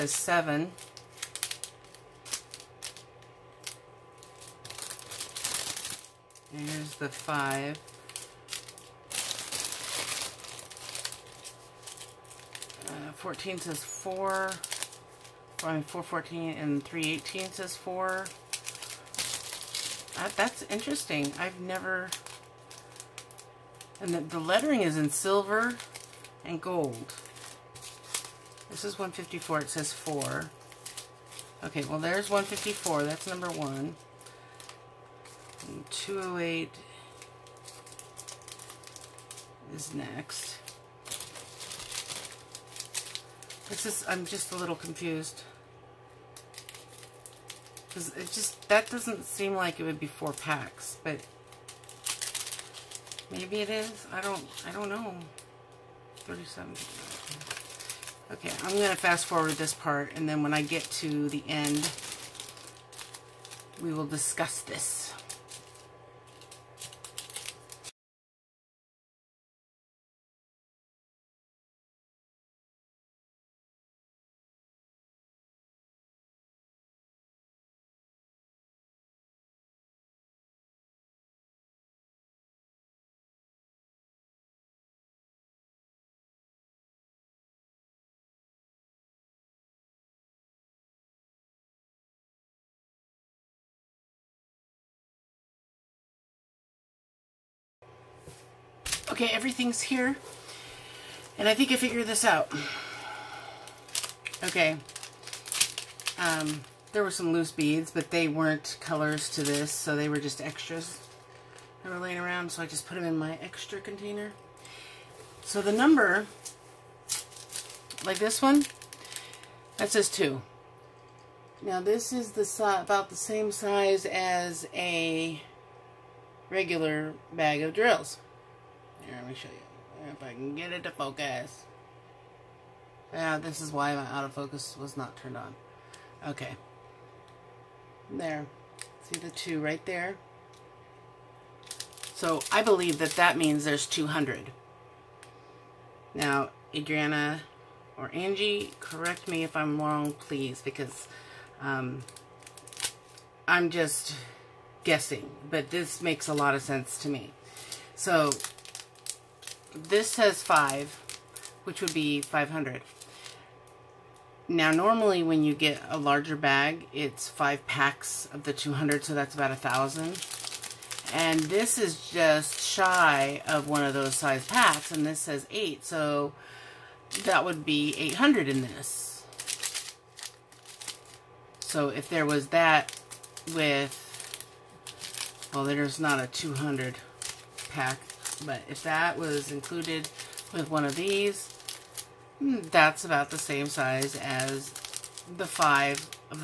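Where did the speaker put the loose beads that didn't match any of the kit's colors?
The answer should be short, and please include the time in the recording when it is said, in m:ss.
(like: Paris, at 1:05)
extra container, at 1:53.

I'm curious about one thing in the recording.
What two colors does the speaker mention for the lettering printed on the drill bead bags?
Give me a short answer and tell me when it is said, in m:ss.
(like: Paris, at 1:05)
silver and gold, at 0:25.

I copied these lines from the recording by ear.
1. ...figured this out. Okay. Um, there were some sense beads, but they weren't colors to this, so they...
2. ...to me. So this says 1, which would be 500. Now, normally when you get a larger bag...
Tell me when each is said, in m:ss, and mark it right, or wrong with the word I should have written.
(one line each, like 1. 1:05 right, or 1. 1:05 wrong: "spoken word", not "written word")
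1. 1:41 wrong: "loose", not "sense"
2. 2:37 wrong: "5", not "1".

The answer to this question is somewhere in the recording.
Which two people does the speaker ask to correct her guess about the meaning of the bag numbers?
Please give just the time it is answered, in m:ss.
2:26.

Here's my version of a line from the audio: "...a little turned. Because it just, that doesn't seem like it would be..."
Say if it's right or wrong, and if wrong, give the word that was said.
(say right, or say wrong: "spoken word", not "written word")
wrong: "confused", not "turned".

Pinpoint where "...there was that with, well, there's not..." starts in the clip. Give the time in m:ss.
3:02.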